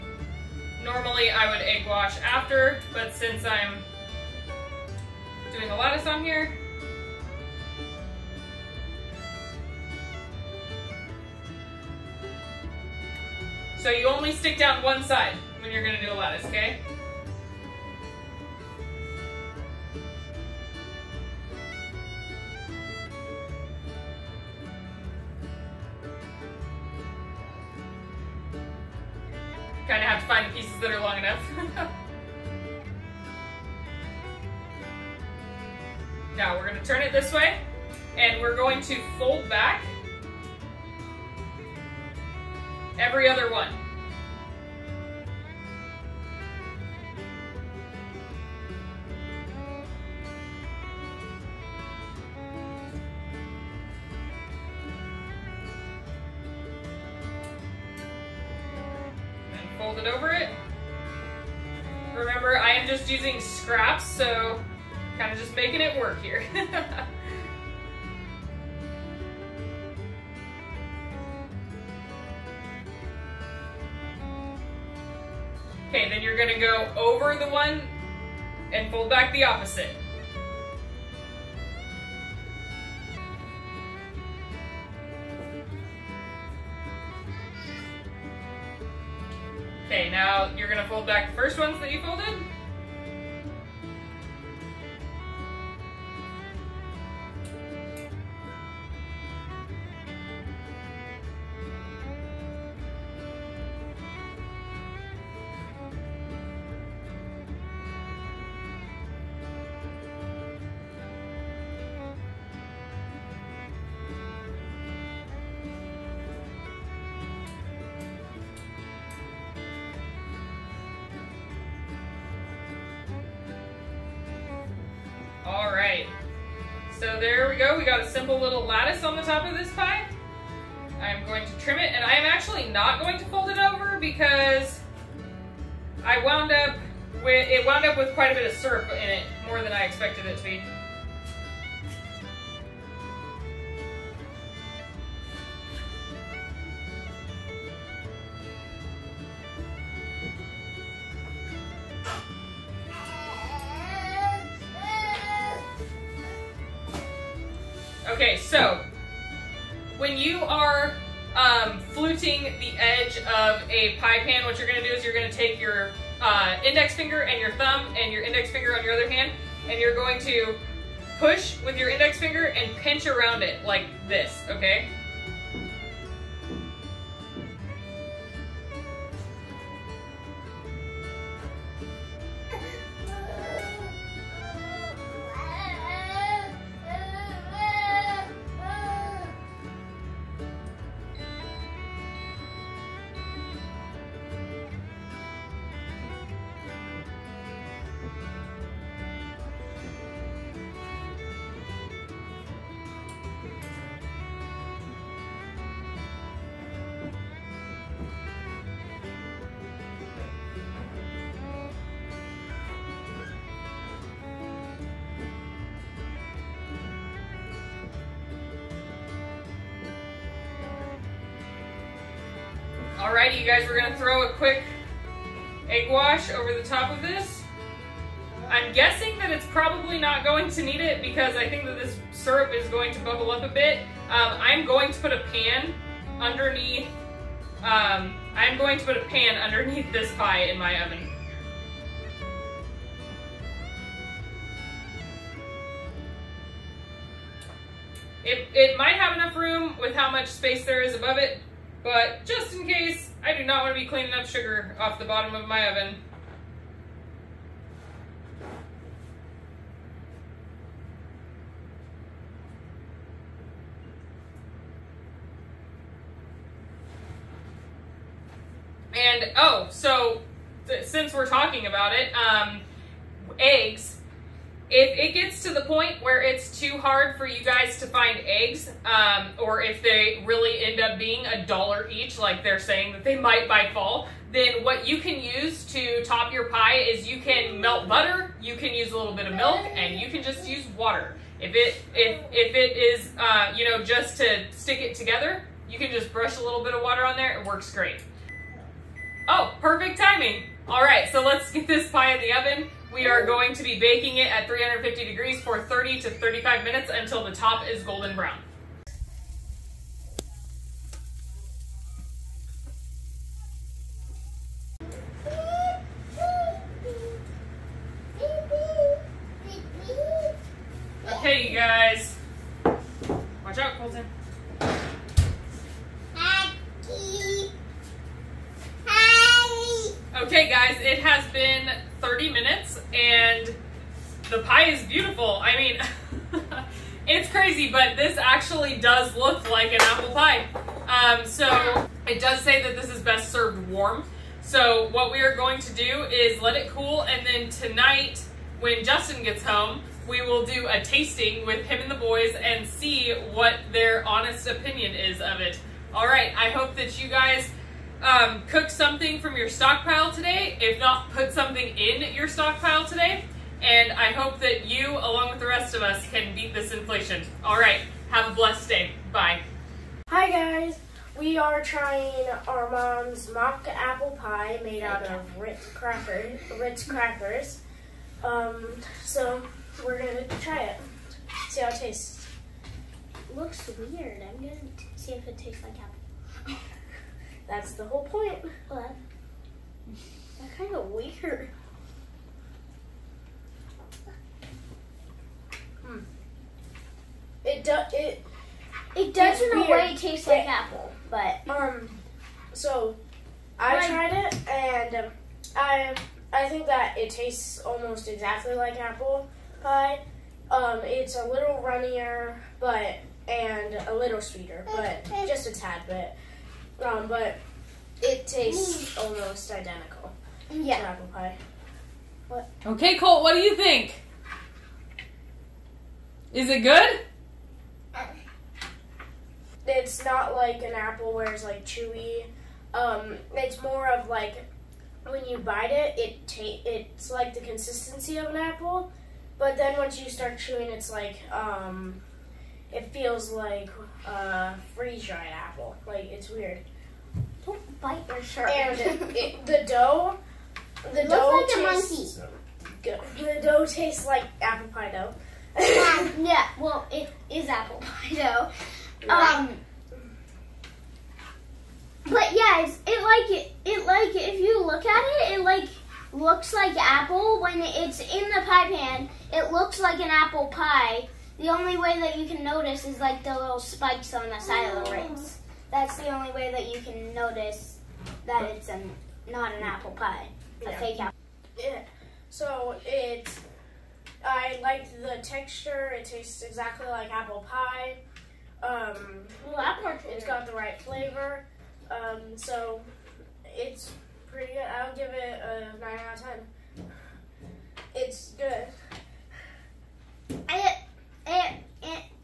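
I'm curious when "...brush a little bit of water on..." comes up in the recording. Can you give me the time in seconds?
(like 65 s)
296 s.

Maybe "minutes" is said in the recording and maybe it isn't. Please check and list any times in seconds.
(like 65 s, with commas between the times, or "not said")
306 s, 332 s.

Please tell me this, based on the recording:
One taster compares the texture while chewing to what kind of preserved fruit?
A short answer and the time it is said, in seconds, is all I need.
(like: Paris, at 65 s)
Freeze dried apple, at 444 s.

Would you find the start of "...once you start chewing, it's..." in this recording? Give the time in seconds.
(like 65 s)
439 s.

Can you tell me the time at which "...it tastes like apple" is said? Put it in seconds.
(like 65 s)
385 s.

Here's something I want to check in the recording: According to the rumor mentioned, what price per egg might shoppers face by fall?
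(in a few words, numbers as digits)
A dollar each.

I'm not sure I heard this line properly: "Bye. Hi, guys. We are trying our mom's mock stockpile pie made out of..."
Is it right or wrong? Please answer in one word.
wrong.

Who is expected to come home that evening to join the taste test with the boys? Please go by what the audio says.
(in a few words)
Justin.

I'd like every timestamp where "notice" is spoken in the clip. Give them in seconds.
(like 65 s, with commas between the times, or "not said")
472 s, 477 s.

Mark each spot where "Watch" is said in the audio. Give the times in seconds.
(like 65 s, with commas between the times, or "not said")
322 s.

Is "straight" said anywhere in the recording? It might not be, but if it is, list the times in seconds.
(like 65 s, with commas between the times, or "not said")
not said.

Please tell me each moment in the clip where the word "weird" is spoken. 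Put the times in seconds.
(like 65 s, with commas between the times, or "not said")
383 s, 390 s, 446 s.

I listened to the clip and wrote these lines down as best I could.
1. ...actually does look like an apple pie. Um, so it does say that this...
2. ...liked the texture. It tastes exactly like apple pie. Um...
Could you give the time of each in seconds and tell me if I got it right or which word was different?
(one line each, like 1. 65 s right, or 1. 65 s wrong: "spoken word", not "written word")
1. 338 s right
2. 484 s right.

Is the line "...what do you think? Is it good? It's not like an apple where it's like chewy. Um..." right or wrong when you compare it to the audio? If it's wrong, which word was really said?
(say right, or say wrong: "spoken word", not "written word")
right.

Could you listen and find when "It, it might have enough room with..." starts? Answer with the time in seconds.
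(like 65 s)
248 s.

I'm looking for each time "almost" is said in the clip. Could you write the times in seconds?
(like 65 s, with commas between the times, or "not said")
407 s, 418 s.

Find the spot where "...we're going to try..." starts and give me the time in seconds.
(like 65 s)
379 s.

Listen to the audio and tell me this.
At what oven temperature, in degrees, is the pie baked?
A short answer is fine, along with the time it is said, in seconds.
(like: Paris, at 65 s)
350 degrees, at 304 s.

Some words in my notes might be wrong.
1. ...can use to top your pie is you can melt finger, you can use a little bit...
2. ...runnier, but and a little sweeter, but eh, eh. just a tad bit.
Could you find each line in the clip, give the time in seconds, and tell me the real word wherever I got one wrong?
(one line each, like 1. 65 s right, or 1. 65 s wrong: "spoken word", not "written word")
1. 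284 s wrong: "butter", not "finger"
2. 411 s right.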